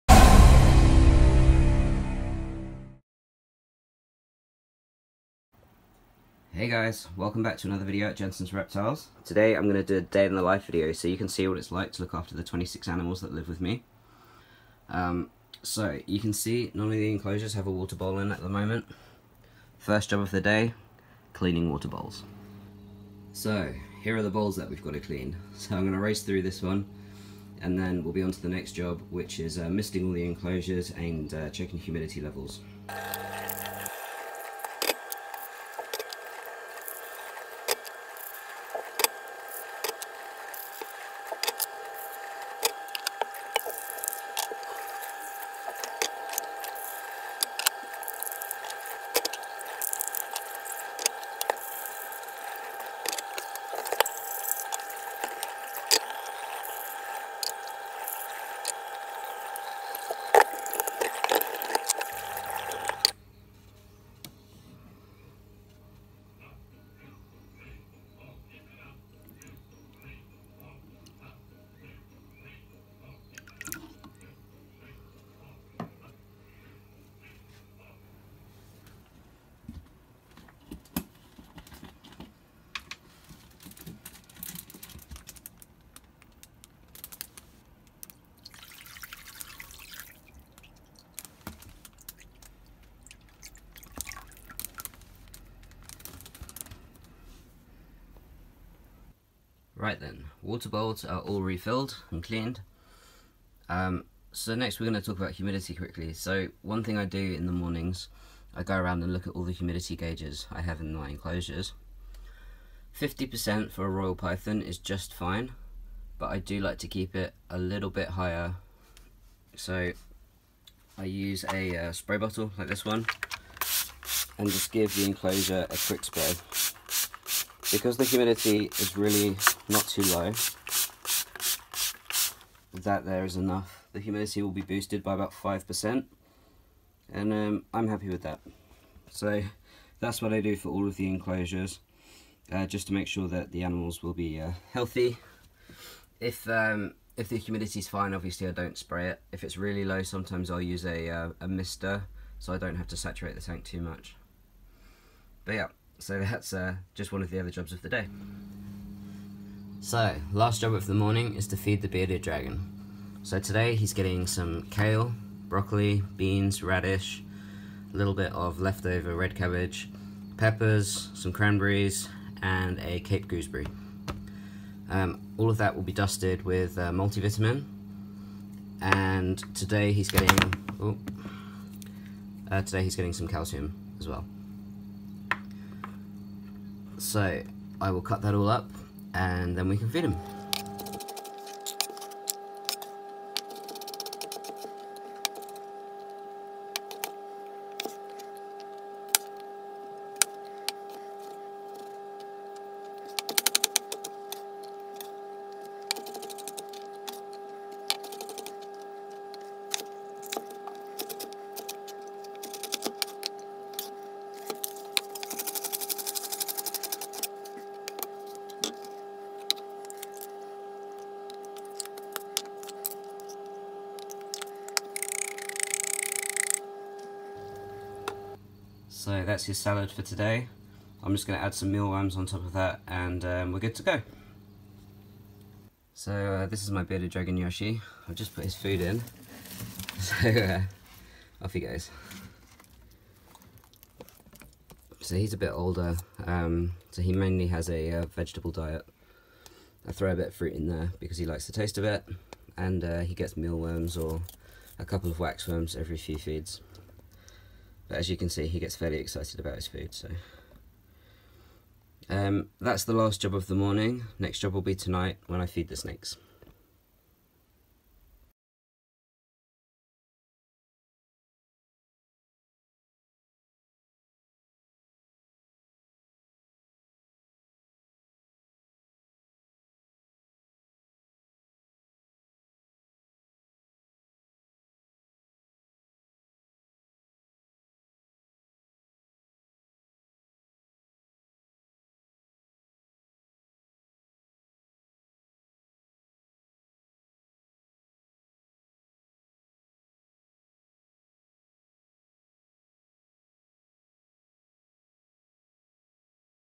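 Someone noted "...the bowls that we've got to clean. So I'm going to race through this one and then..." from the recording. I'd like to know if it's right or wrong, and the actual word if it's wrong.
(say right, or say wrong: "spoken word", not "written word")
right.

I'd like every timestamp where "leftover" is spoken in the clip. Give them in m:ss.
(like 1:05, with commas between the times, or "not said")
2:48.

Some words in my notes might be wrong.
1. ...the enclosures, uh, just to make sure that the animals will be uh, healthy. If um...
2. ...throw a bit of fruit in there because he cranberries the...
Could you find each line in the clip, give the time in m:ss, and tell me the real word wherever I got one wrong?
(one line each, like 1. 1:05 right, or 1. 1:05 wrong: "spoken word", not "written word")
1. 2:20 right
2. 4:09 wrong: "likes", not "cranberries".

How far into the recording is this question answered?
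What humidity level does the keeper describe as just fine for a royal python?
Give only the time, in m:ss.
1:53.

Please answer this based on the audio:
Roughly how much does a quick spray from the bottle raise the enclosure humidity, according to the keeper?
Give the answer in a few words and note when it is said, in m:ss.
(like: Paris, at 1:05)
5%, at 2:15.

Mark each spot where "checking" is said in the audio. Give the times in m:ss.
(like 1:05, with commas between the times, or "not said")
0:31.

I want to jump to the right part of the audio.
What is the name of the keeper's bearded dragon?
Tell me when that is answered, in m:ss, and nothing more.
3:57.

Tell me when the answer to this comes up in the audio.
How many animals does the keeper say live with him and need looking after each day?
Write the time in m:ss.
0:12.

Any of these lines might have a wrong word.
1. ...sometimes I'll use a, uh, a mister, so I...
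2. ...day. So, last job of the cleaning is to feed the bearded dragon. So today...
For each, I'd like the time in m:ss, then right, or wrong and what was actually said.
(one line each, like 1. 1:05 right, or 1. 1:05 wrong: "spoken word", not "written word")
1. 2:30 right
2. 2:37 wrong: "morning", not "cleaning".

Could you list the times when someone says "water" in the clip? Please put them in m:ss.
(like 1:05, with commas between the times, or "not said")
0:17, 0:21, 1:40.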